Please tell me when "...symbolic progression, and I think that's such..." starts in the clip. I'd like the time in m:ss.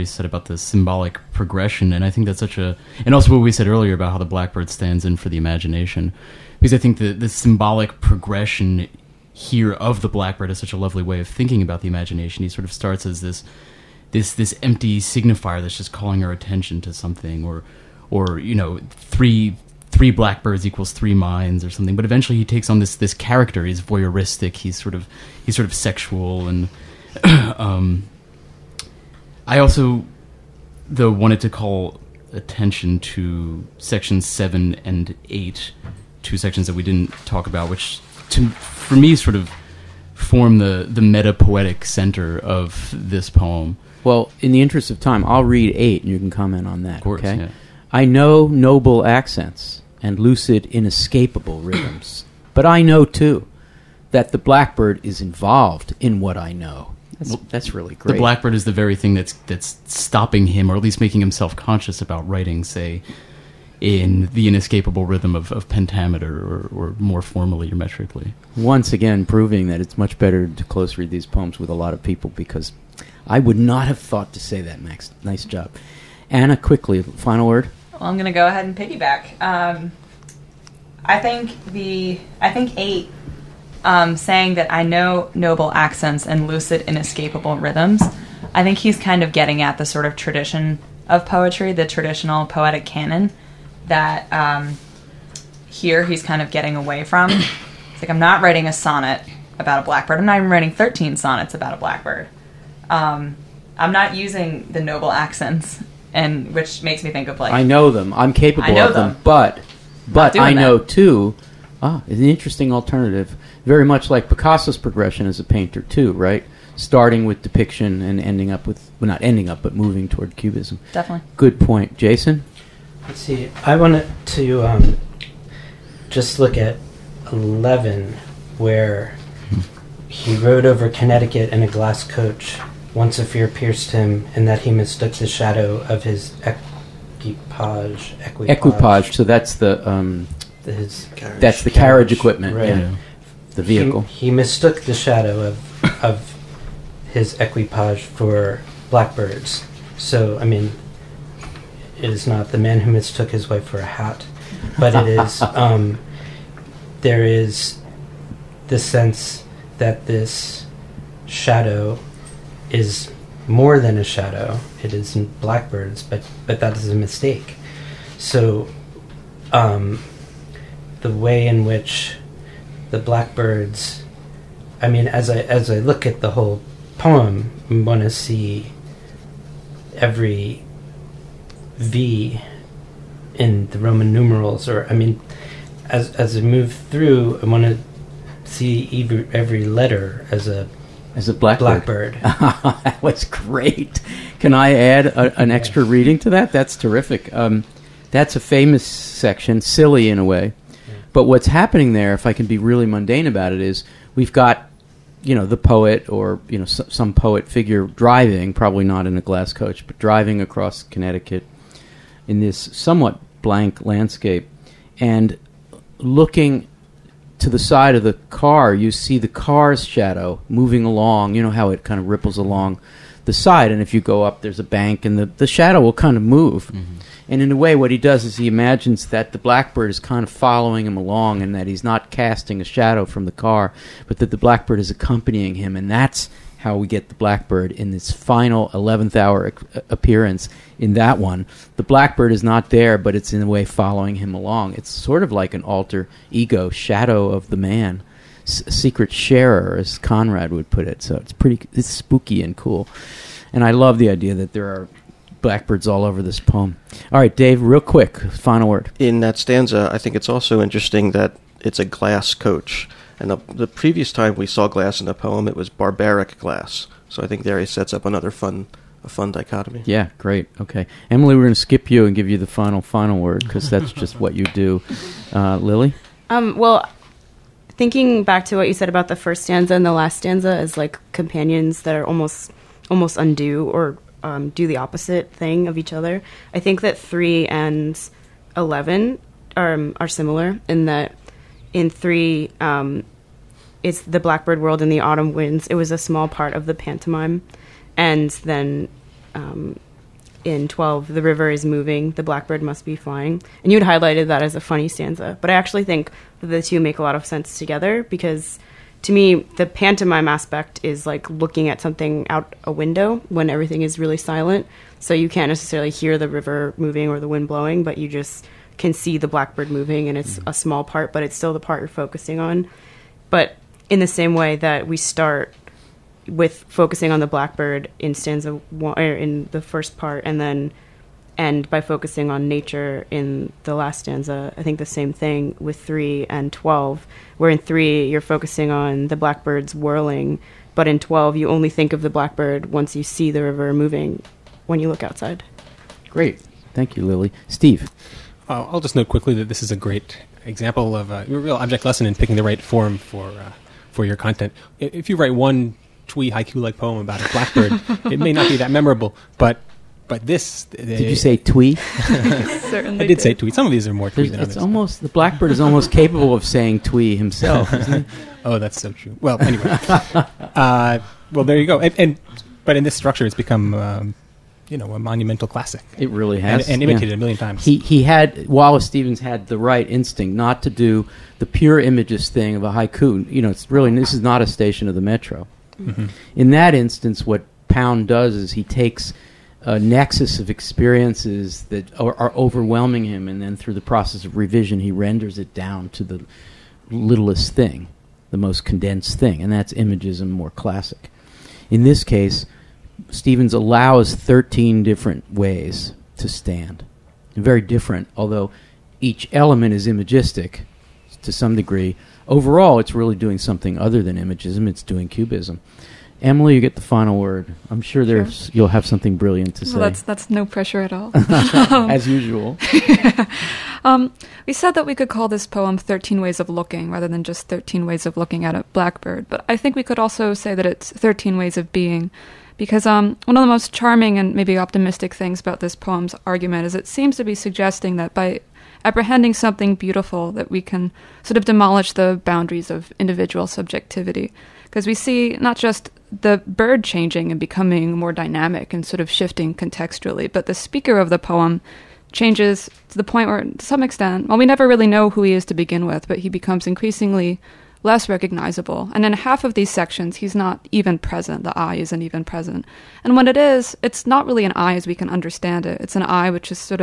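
0:00.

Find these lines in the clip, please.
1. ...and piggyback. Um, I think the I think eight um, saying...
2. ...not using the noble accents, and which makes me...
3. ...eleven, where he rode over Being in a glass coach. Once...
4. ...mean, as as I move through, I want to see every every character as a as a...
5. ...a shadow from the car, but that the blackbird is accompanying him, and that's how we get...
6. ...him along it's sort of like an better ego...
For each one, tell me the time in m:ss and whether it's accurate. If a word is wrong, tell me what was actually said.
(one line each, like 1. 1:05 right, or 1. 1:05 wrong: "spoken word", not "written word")
1. 1:18 right
2. 1:43 right
3. 2:07 wrong: "Connecticut", not "Being"
4. 3:04 wrong: "letter", not "character"
5. 3:52 right
6. 4:04 wrong: "alter", not "better".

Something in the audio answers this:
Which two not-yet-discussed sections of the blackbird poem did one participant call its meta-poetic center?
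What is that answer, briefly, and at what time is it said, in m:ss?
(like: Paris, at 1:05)
7 and 8, at 0:33.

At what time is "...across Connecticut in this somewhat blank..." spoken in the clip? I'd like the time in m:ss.
3:30.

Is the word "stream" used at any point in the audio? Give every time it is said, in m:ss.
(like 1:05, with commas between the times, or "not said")
not said.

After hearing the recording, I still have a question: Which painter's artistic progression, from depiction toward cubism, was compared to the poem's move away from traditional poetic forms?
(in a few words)
Picasso.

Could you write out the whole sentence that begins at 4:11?
So it's pretty, it's spooky and cool.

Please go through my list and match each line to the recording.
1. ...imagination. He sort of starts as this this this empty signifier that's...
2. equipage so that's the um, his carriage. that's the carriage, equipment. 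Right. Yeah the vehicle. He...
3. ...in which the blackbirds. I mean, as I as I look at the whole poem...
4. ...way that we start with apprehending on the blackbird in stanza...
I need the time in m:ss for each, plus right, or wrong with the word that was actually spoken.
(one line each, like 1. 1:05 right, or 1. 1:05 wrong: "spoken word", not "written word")
1. 0:11 right
2. 2:18 right
3. 2:51 right
4. 5:24 wrong: "focusing", not "apprehending".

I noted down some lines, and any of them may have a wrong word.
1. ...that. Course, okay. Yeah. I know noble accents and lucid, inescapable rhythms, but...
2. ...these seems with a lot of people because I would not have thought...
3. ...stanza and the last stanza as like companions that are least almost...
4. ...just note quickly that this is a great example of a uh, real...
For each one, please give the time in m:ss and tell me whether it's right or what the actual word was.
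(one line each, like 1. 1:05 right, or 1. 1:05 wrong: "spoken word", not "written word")
1. 0:46 right
2. 1:11 wrong: "poems", not "seems"
3. 4:39 wrong: "almost", not "least"
4. 5:48 right.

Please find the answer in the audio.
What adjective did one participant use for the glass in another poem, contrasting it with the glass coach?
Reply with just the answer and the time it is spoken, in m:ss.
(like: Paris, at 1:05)
barbaric, at 4:25.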